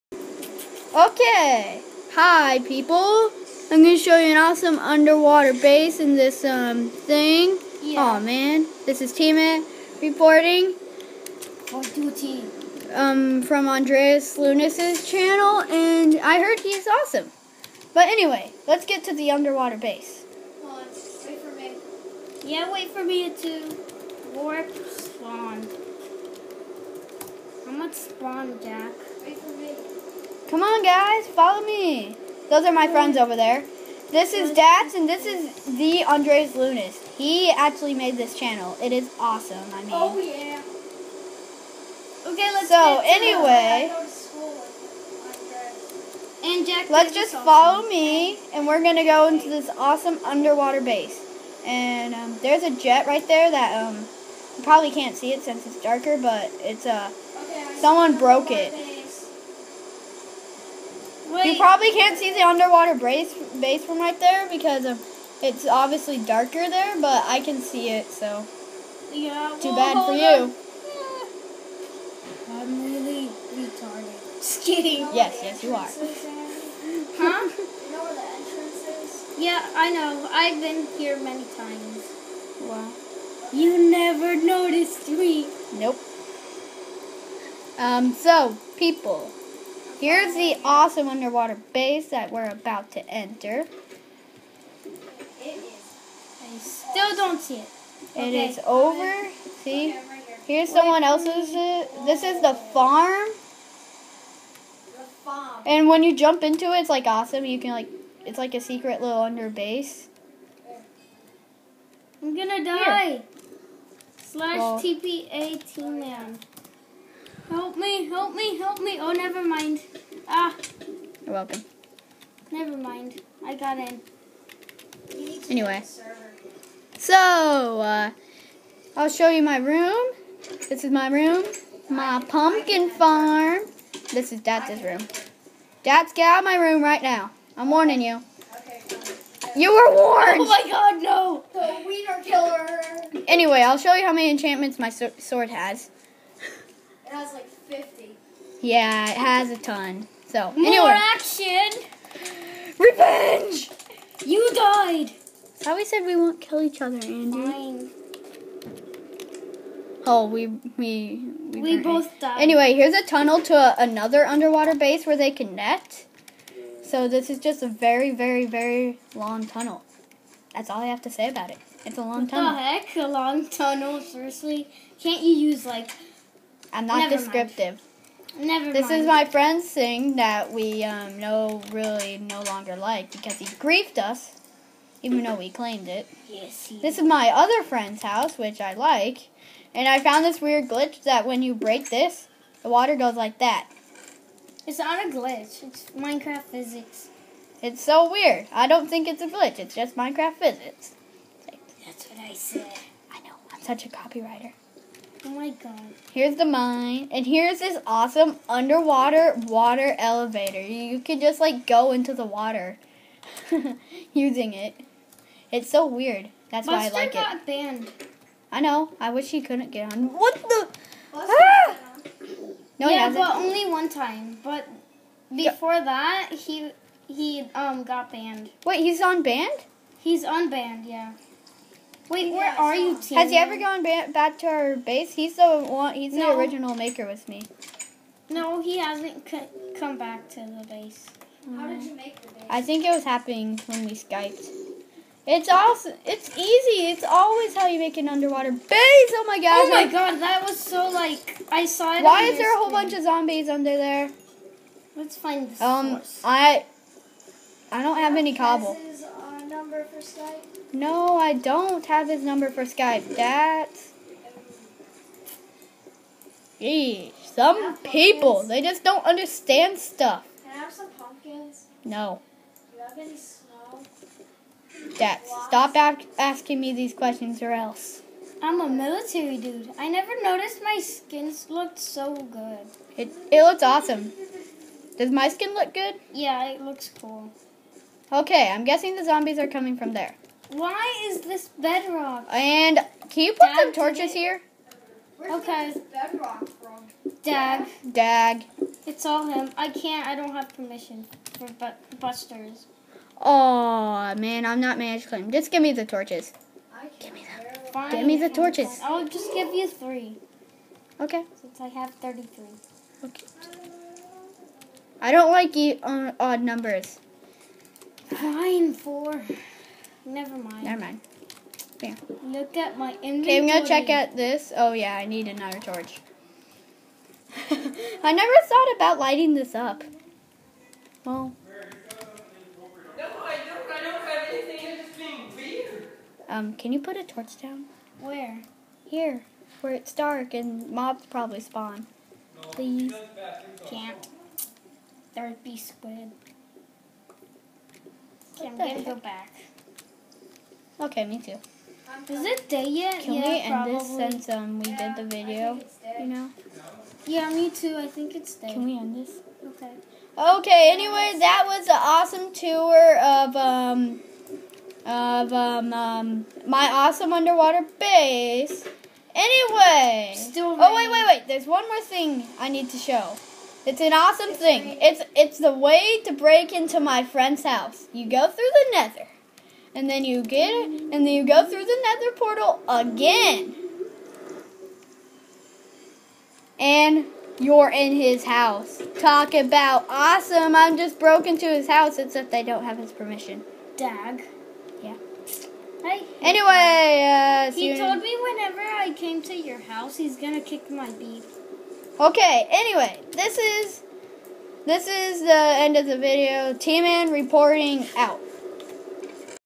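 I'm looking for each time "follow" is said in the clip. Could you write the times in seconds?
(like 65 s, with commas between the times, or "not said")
31 s, 47 s.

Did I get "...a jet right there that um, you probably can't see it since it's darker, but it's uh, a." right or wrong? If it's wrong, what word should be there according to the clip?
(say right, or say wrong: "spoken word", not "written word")
right.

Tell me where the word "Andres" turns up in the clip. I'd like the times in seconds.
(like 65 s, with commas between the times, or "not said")
13 s, 36 s.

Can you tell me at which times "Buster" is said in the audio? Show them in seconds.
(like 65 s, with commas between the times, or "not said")
216 s, 302 s.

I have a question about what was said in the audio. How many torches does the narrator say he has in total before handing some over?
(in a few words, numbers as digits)
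33.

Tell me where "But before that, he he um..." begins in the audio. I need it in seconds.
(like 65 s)
224 s.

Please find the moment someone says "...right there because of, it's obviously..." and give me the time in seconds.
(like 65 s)
63 s.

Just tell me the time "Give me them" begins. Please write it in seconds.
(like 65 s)
306 s.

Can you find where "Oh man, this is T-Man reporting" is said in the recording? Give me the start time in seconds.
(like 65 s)
8 s.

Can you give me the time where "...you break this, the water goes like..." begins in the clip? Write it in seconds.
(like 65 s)
191 s.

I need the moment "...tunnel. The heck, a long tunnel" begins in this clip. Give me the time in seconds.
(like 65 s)
172 s.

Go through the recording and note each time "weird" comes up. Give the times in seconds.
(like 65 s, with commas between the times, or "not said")
190 s, 198 s, 215 s, 335 s.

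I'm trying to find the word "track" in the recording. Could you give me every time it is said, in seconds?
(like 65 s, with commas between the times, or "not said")
not said.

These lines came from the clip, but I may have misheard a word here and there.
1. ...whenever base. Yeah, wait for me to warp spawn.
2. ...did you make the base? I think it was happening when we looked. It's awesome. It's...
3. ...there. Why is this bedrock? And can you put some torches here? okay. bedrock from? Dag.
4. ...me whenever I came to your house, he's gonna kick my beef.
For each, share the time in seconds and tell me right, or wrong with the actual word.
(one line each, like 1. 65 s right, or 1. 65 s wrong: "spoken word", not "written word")
1. 19 s wrong: "underwater", not "whenever"
2. 241 s wrong: "skyped", not "looked"
3. 289 s right
4. 398 s right.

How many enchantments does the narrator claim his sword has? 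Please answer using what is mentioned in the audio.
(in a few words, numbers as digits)
50.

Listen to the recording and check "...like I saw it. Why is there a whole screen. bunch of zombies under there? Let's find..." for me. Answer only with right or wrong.
right.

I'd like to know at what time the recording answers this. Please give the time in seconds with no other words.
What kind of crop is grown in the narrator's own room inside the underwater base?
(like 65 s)
131 s.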